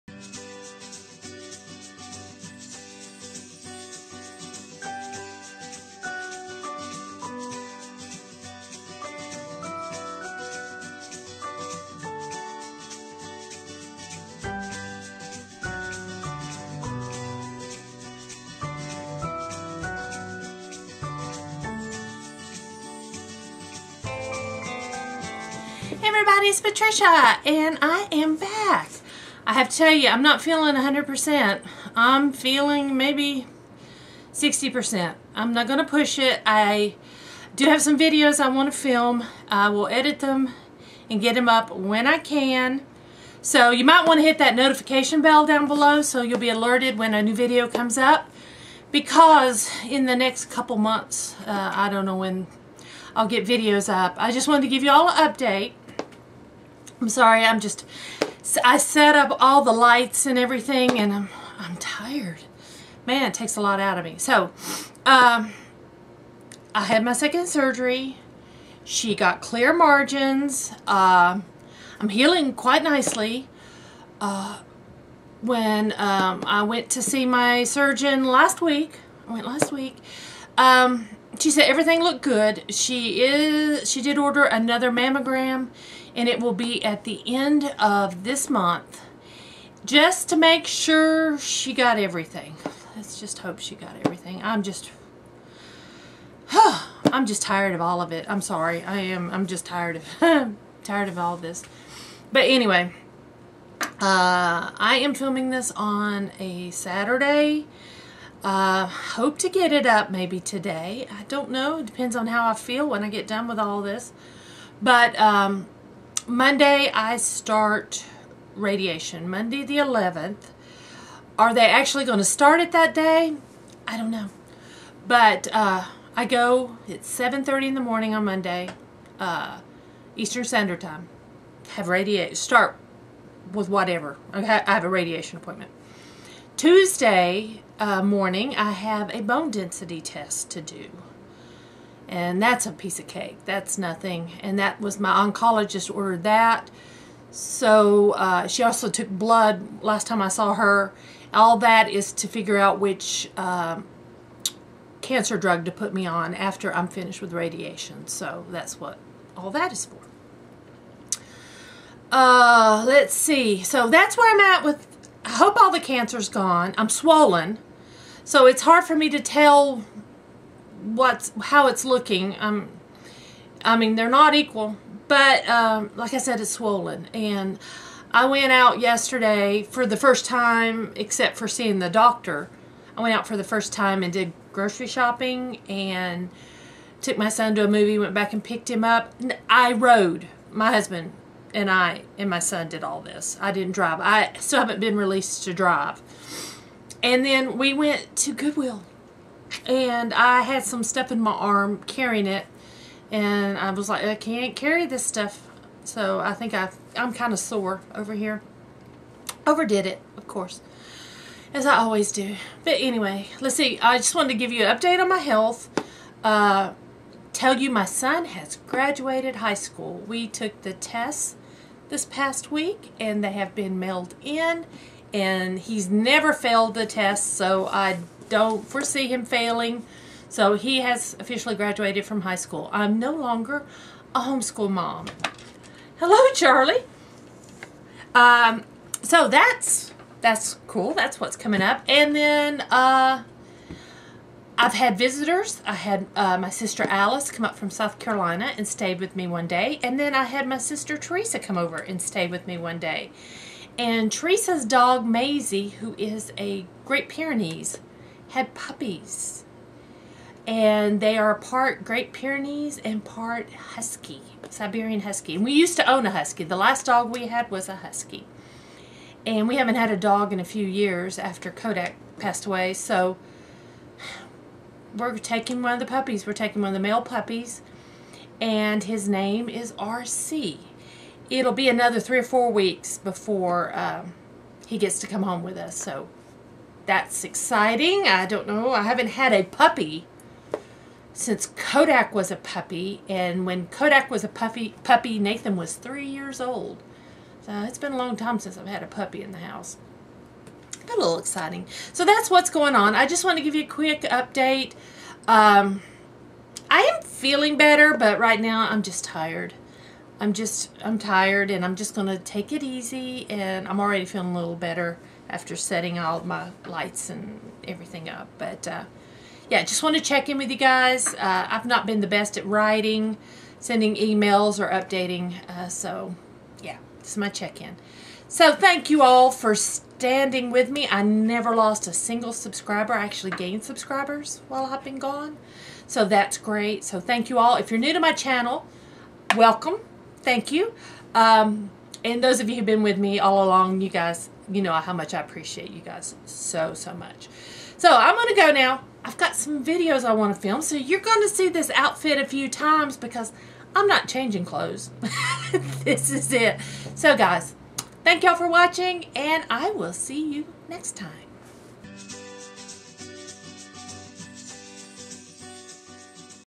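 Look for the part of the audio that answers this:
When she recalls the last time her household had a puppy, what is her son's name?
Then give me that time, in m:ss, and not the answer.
4:55.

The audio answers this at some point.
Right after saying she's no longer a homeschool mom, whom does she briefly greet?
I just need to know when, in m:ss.
3:56.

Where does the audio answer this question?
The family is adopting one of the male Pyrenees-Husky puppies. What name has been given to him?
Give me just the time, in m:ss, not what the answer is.
4:39.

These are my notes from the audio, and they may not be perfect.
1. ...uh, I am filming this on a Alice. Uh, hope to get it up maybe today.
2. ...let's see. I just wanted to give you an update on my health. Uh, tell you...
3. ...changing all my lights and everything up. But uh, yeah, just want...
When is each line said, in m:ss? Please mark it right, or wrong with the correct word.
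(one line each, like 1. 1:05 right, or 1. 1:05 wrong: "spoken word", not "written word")
1. 1:43 wrong: "Saturday", not "Alice"
2. 3:33 right
3. 5:15 wrong: "setting", not "changing".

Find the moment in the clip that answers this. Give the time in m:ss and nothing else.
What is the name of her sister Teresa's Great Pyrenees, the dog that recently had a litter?
4:15.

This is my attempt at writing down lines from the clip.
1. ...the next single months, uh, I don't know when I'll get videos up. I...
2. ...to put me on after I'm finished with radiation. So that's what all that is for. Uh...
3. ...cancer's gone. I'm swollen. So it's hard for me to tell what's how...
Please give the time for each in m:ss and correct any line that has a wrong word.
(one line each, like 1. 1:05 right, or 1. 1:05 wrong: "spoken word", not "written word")
1. 0:50 wrong: "couple", not "single"
2. 2:35 right
3. 2:45 right.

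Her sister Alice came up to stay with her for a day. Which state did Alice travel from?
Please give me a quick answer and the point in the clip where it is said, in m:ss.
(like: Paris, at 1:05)
South Carolina, at 4:07.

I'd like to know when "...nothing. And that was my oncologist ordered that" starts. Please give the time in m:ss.
2:23.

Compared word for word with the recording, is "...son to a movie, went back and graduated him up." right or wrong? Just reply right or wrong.
wrong.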